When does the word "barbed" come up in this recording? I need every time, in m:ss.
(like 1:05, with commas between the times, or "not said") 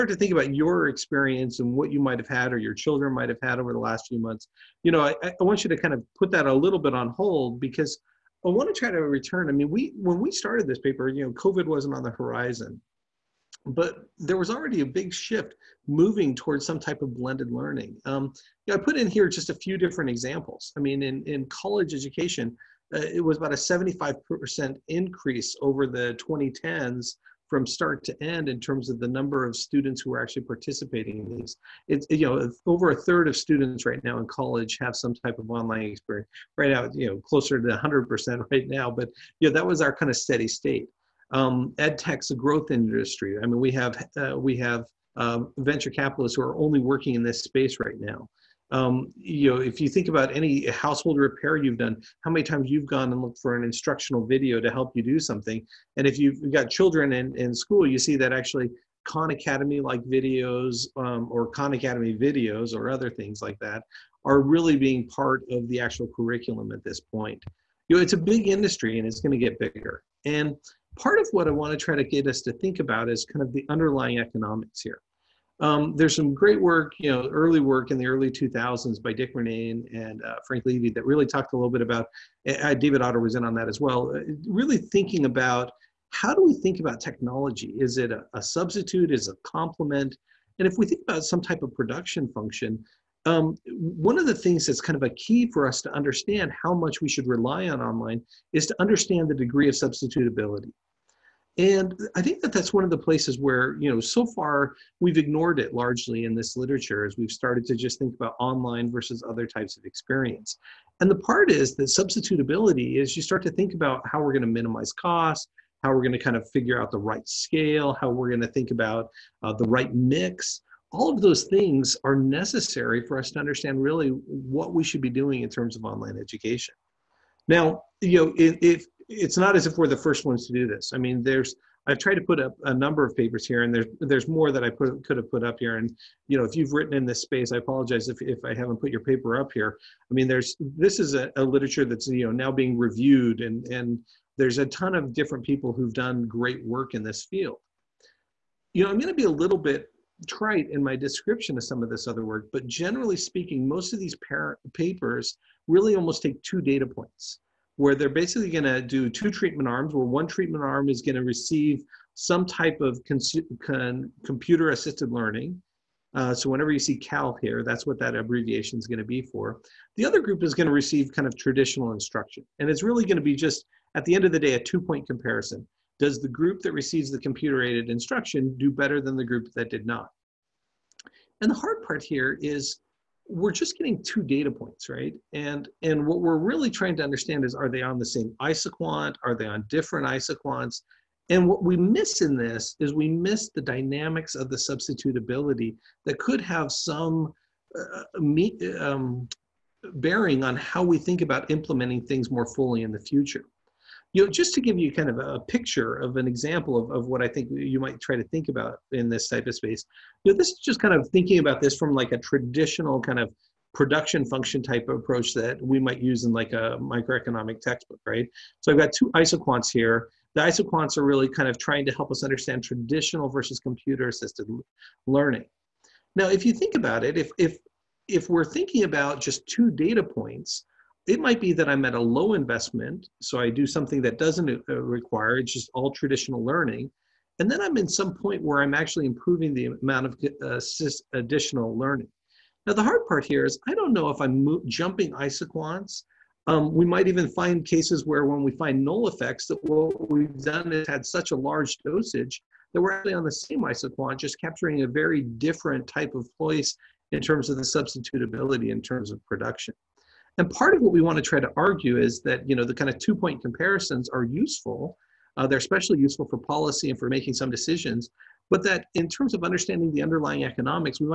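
not said.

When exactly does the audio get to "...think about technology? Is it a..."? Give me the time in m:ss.
1:26.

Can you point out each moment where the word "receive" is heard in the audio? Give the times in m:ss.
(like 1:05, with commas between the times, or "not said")
2:41, 2:50, 2:56.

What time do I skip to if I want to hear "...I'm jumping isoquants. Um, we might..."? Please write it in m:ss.
4:04.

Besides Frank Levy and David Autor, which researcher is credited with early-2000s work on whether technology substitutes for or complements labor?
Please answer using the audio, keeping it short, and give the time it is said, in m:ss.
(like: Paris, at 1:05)
Dick Murnane, at 1:19.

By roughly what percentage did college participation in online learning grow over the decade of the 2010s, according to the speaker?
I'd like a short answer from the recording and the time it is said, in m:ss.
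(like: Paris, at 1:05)
75%, at 0:23.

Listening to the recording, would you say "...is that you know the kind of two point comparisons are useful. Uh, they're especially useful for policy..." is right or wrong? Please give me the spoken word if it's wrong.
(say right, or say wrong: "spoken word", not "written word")
right.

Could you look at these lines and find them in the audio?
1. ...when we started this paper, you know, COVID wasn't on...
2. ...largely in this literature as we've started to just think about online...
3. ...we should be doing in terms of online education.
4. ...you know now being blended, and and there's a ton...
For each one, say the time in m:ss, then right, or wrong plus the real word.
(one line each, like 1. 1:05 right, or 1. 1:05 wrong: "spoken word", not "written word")
1. 0:09 right
2. 1:45 right
3. 2:04 right
4. 2:22 wrong: "reviewed", not "blended".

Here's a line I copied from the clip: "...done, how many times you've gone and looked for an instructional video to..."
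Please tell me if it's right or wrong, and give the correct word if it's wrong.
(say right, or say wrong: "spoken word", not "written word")
right.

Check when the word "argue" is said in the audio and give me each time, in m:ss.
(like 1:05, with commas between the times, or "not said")
4:21.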